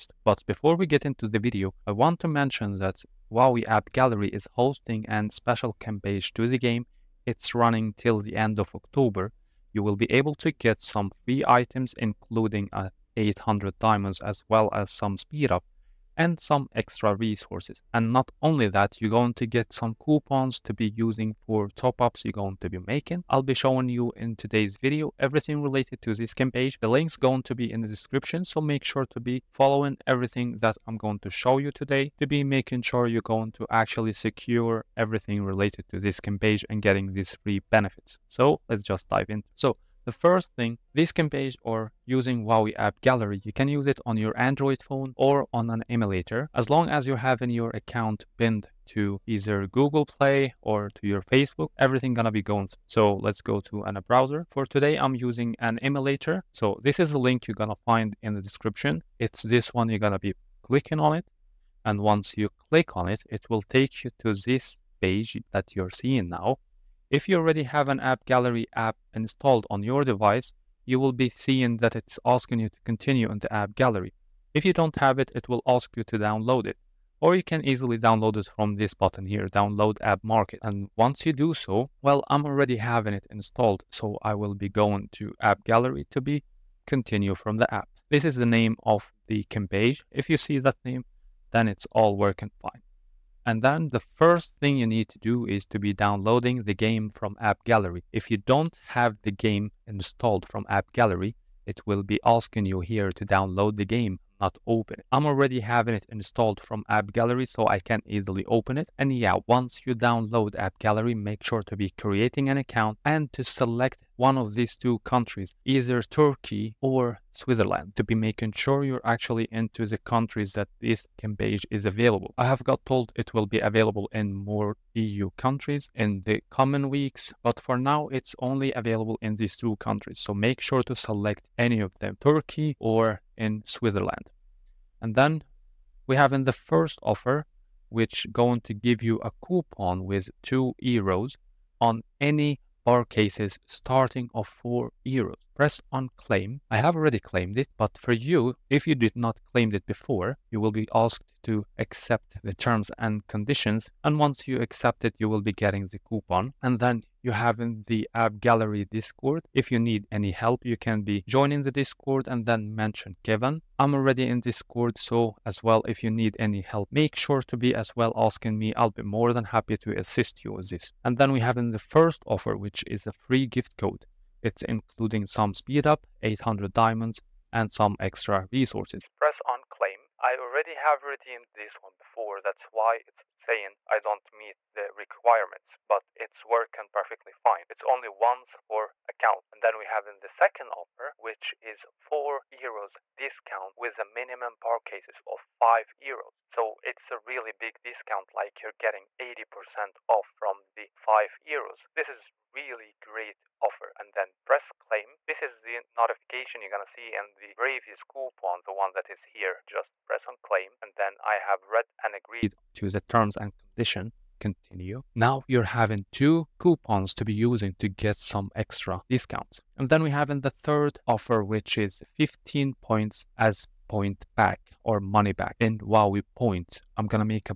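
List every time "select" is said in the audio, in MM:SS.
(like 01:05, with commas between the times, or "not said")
01:53, 02:10.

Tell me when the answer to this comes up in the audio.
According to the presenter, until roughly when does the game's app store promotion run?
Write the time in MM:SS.
00:07.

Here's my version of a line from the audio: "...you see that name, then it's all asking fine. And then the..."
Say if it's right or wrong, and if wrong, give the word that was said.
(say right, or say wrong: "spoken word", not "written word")
wrong: "working", not "asking".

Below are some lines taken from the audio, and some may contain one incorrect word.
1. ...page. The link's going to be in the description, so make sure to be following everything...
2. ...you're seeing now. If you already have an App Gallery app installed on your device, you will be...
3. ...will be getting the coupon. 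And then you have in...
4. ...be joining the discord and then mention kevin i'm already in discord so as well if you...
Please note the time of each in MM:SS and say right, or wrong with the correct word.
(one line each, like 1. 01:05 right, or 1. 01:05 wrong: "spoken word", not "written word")
1. 00:26 right
2. 01:05 right
3. 02:35 right
4. 02:41 right.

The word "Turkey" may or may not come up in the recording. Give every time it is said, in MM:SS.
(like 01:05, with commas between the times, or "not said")
01:56, 02:12.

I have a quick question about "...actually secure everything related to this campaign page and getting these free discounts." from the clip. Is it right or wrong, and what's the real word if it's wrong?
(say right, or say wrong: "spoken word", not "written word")
wrong: "benefits", not "discounts".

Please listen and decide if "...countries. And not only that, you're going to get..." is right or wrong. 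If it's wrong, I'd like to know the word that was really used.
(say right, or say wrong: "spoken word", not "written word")
wrong: "resources", not "countries".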